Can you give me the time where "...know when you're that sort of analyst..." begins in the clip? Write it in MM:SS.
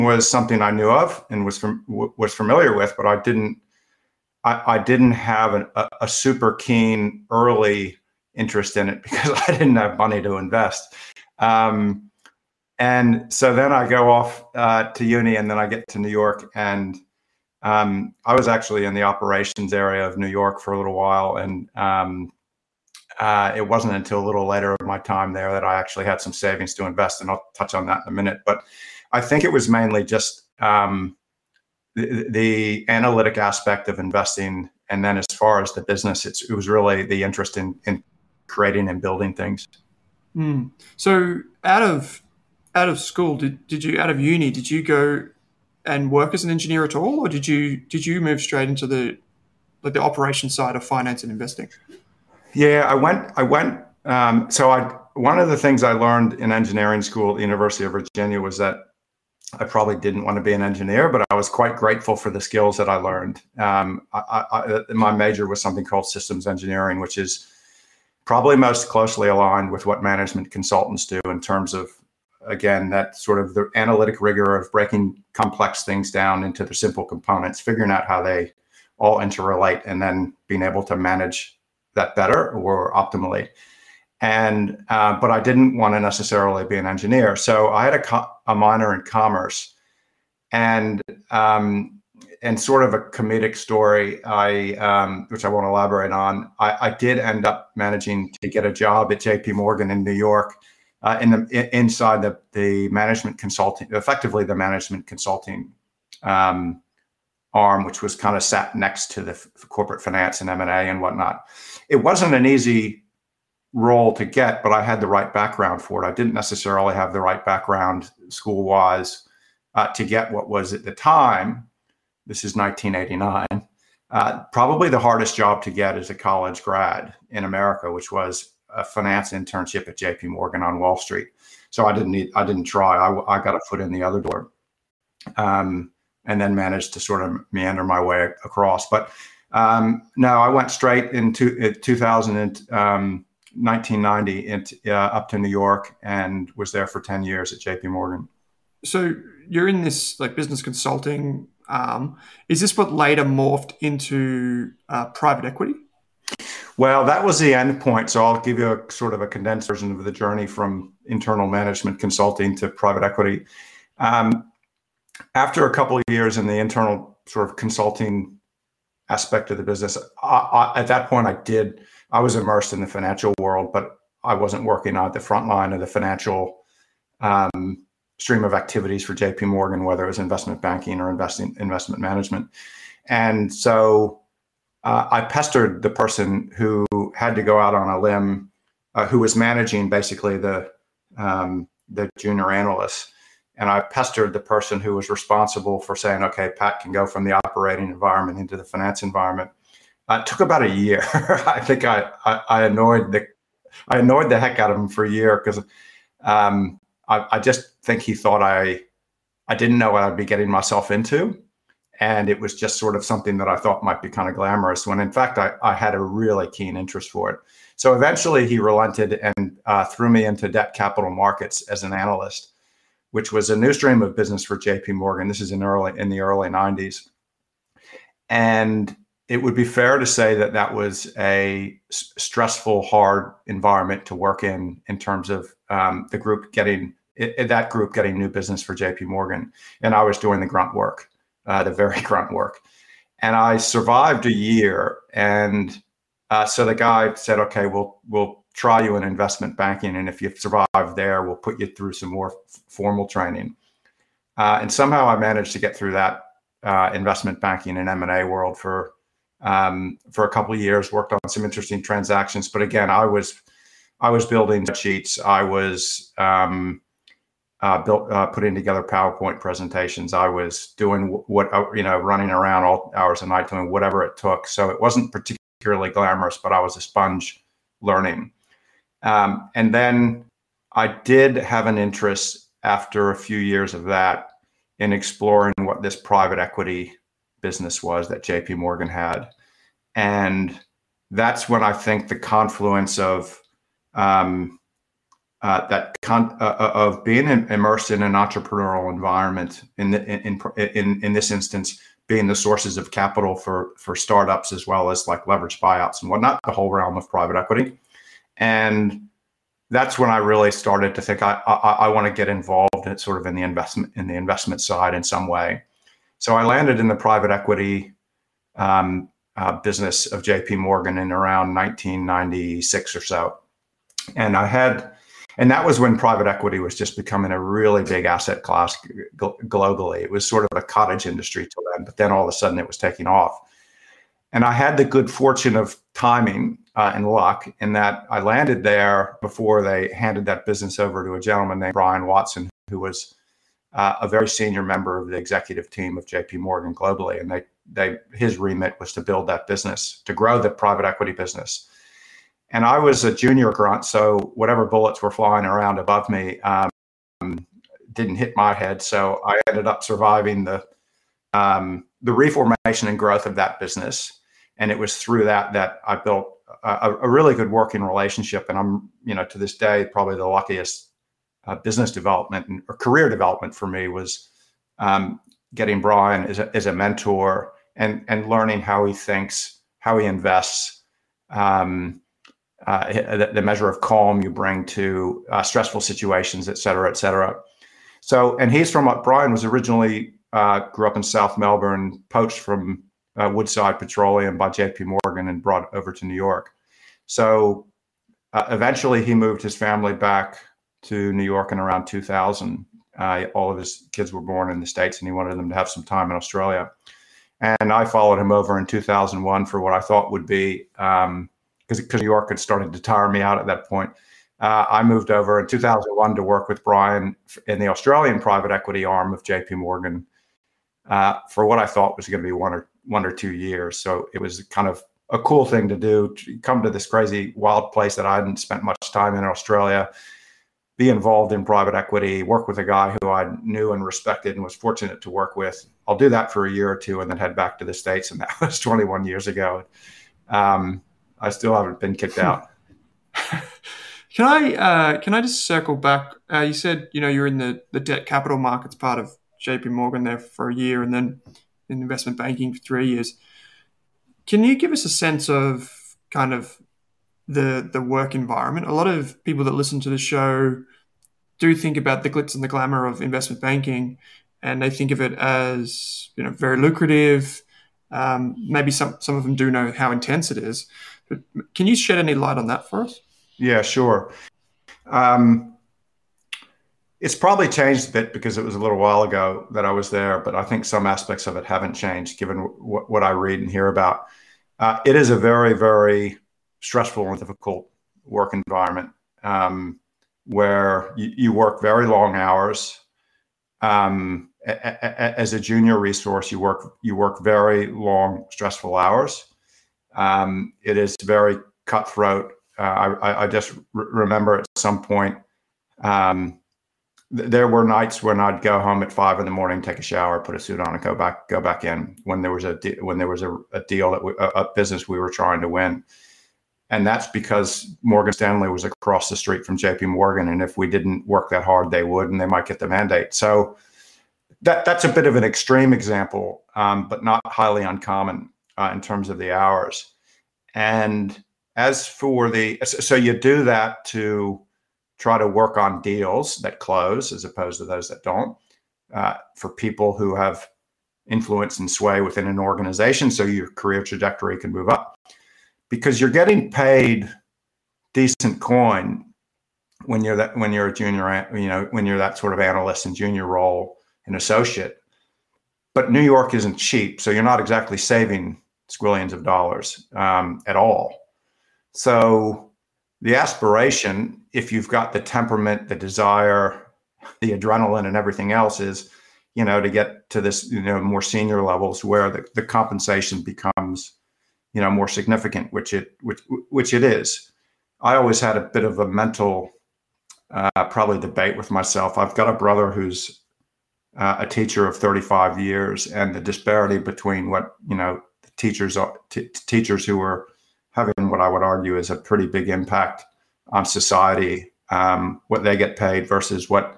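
09:11.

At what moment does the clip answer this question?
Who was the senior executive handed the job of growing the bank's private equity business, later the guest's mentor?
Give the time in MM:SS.
05:41.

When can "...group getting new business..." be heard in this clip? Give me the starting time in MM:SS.
03:57.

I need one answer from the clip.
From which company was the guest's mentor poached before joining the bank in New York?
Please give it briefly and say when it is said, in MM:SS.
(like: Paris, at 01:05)
Woodside Petroleum, at 06:33.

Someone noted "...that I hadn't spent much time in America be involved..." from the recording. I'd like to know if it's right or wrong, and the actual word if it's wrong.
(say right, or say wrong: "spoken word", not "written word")
wrong: "Australia", not "America".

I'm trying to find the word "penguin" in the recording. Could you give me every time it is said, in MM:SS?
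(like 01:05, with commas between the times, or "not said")
not said.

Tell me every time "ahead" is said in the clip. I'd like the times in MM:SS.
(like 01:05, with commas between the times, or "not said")
not said.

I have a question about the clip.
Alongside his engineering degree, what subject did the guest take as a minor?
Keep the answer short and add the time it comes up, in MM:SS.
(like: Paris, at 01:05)
Commerce, at 01:29.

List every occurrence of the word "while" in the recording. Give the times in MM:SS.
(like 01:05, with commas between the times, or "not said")
00:20, 07:58.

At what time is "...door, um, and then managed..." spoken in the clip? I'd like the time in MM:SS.
02:14.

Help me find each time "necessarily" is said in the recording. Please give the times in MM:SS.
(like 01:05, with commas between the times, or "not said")
01:26, 01:56.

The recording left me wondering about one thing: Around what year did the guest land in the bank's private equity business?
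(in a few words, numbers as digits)
1996.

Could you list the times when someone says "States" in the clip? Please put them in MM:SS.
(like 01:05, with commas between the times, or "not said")
06:44, 07:17.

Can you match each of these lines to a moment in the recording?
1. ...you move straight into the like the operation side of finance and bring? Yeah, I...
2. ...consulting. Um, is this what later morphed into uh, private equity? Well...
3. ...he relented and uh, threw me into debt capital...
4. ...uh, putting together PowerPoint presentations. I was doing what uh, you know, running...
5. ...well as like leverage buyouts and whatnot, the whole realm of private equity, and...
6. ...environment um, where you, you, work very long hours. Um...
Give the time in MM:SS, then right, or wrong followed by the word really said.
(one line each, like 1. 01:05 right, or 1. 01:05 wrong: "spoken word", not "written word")
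1. 00:48 wrong: "investing", not "bring"
2. 02:30 right
3. 03:38 right
4. 04:28 right
5. 05:04 right
6. 08:08 right.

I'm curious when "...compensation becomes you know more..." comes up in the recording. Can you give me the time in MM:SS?
09:32.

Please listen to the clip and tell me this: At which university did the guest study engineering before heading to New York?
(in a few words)
University of Virginia.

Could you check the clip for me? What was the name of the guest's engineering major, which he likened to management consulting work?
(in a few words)
Systems engineering.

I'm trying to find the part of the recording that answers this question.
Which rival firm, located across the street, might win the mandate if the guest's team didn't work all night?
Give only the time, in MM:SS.
08:37.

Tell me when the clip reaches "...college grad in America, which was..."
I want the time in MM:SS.
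02:06.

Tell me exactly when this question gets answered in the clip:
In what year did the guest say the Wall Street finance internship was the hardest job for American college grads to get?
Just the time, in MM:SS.
02:02.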